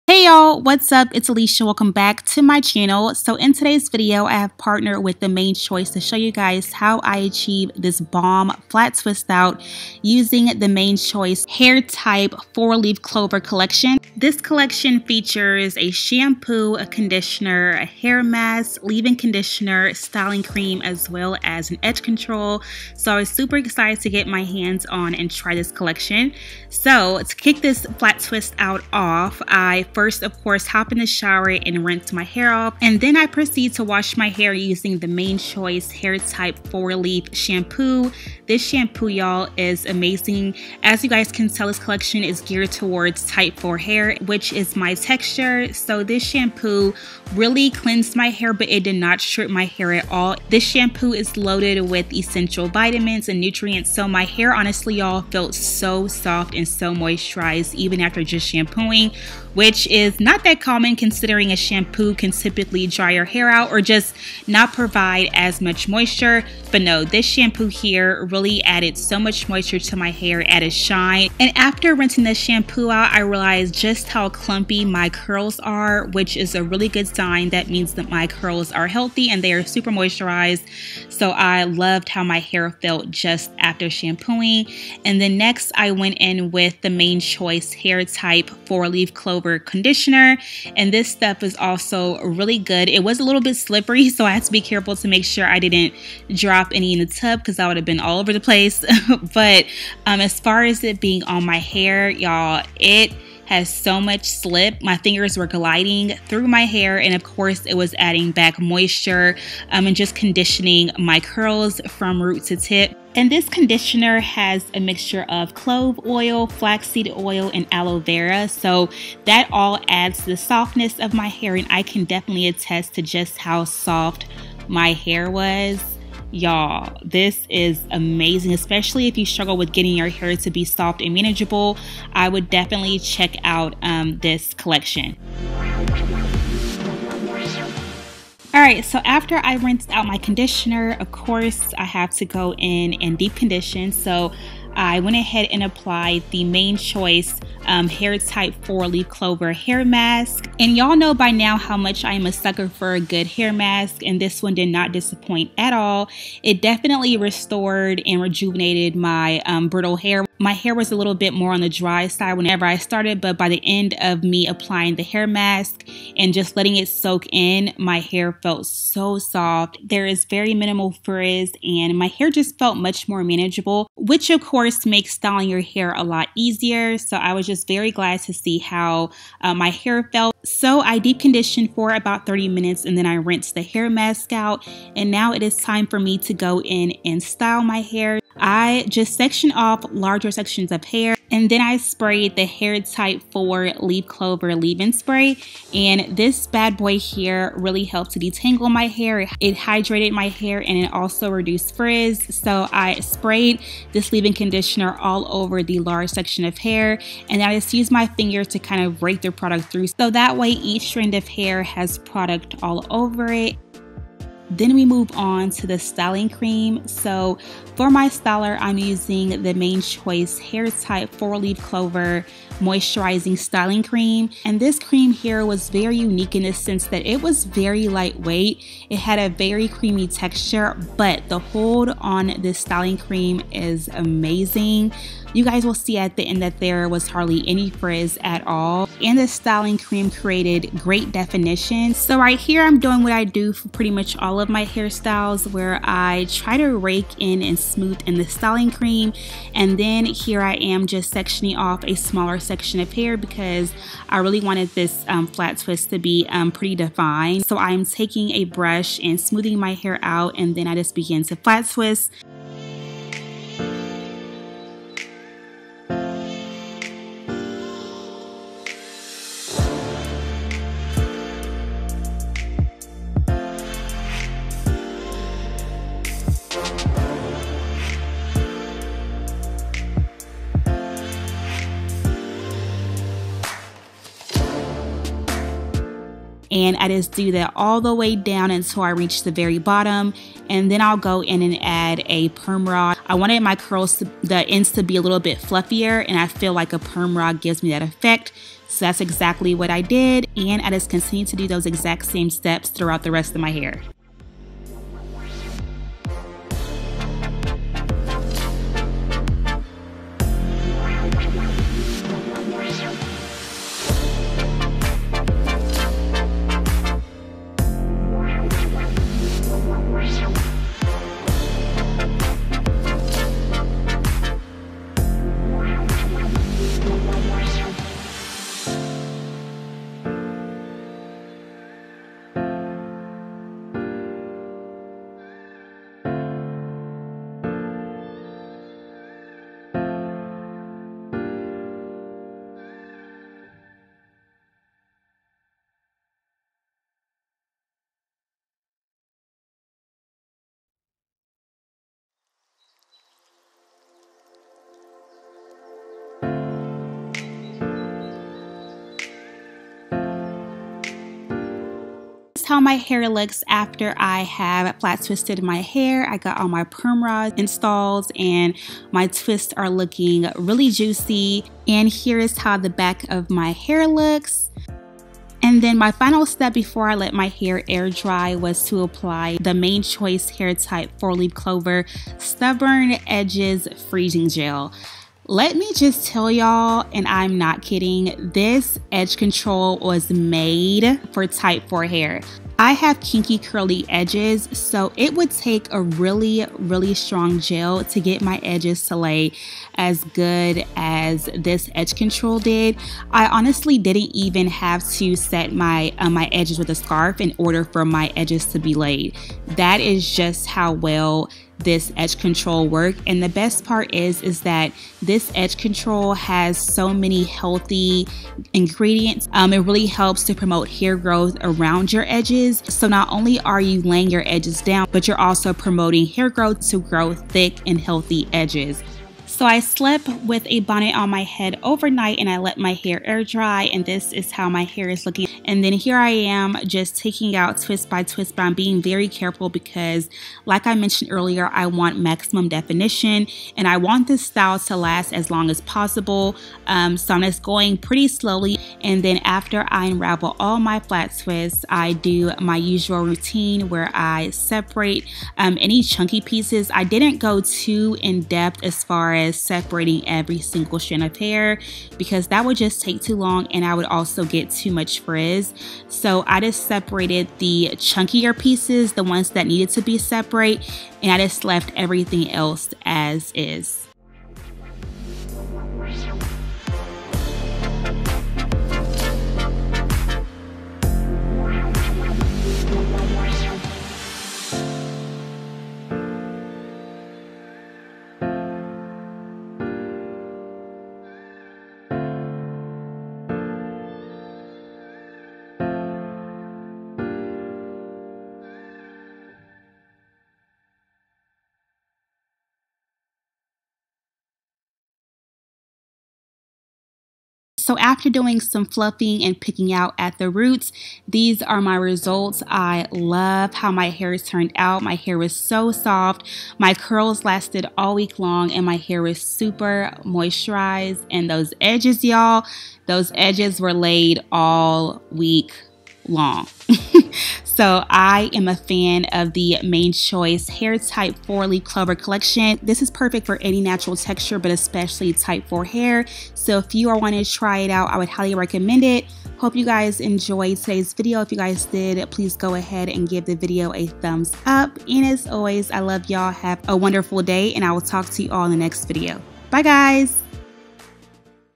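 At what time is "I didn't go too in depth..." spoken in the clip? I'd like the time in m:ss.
7:36.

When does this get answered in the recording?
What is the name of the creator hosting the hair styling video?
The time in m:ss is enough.
0:01.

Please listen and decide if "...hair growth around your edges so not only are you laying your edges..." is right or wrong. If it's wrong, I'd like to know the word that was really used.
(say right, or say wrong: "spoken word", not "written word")
right.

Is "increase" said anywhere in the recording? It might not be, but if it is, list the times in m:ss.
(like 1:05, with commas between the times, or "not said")
not said.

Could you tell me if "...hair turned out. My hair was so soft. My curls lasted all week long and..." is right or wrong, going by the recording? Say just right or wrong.
right.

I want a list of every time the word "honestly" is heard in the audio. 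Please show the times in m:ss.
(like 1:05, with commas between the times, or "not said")
0:54, 6:43.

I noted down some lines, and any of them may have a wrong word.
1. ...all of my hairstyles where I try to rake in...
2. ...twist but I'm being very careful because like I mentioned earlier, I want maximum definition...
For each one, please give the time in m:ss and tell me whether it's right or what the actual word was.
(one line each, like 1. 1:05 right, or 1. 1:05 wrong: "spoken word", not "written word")
1. 4:04 right
2. 7:18 right.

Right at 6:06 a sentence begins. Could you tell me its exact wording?
I got all my perm rods installed and my twists are looking really juicy.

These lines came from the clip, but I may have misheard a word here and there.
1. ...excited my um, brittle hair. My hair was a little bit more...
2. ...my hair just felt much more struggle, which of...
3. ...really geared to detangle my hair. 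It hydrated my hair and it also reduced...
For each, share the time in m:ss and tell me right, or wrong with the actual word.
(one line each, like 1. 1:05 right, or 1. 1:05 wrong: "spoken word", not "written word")
1. 2:38 wrong: "rejuvenated", not "excited"
2. 2:51 wrong: "manageable", not "struggle"
3. 3:17 wrong: "helped", not "geared".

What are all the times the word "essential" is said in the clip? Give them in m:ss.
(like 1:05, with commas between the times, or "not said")
0:52.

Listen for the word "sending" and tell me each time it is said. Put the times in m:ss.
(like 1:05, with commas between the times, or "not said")
not said.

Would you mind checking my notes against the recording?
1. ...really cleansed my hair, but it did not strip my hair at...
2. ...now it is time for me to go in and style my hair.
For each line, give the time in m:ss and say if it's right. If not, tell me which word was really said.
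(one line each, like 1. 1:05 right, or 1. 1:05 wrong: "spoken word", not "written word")
1. 0:47 right
2. 3:05 right.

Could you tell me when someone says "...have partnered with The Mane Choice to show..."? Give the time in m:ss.
0:04.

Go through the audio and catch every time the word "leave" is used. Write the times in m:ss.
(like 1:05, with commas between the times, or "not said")
0:18, 3:14, 3:24.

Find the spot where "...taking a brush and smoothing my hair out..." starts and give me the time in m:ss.
4:17.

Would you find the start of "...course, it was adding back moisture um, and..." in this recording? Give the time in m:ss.
1:47.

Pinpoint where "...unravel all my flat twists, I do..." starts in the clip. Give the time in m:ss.
7:29.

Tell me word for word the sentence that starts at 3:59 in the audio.
And the styling cream created great definition.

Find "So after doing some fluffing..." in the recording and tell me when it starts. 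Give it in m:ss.
8:27.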